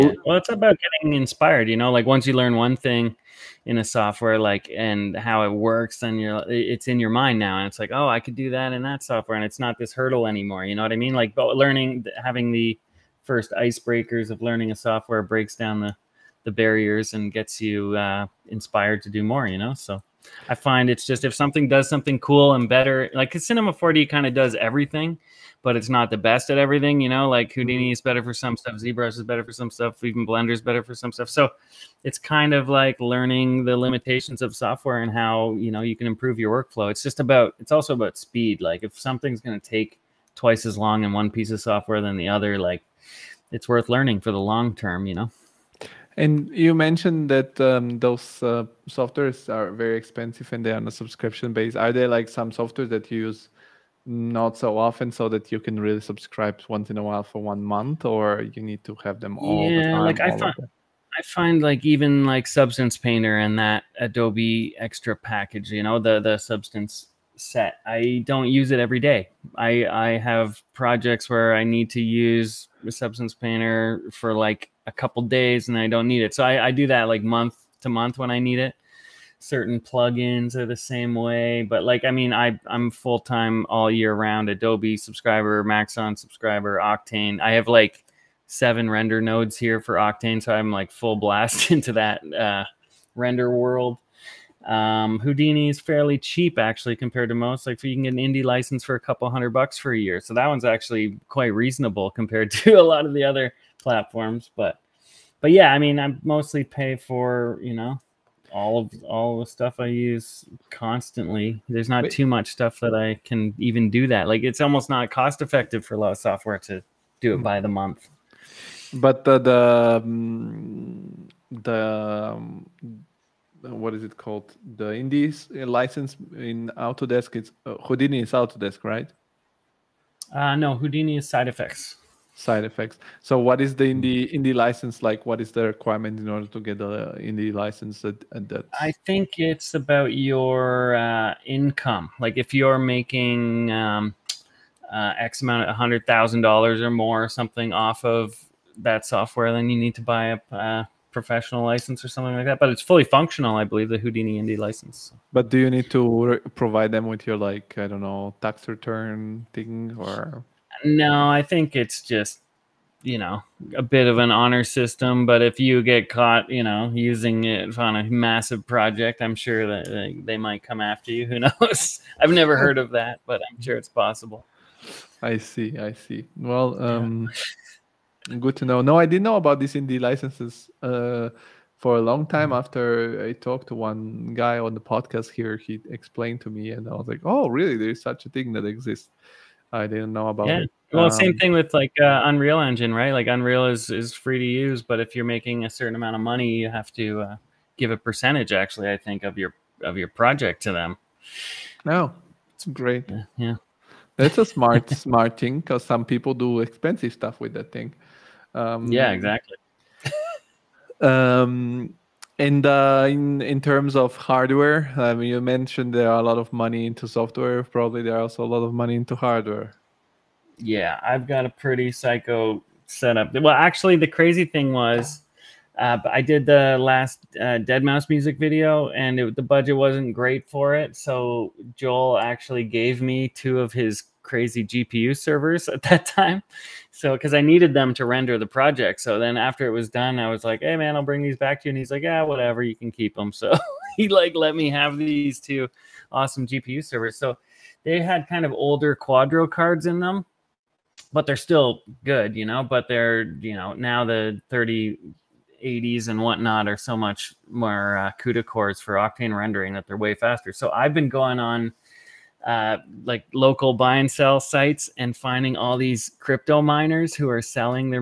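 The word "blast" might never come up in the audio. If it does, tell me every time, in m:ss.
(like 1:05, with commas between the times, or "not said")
1:31.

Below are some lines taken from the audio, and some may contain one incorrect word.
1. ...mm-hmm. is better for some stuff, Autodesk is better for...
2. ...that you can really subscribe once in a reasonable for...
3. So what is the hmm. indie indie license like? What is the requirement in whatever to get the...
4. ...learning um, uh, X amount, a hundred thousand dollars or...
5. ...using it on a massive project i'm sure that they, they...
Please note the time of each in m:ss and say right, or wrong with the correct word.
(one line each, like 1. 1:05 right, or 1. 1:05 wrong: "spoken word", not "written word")
1. 0:27 wrong: "ZBrush", not "Autodesk"
2. 0:55 wrong: "while", not "reasonable"
3. 2:13 wrong: "order", not "whatever"
4. 2:22 wrong: "making", not "learning"
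5. 2:46 right.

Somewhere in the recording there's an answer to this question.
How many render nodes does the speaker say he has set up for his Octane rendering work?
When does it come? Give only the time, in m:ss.
1:28.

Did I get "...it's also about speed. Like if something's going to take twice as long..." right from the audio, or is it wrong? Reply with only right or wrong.
right.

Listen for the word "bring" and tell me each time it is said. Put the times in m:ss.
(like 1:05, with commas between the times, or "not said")
4:01.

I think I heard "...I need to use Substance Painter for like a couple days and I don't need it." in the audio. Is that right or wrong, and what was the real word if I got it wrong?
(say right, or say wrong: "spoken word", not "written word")
right.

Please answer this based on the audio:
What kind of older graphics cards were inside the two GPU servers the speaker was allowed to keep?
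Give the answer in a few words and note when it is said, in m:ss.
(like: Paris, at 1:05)
Quadro, at 4:08.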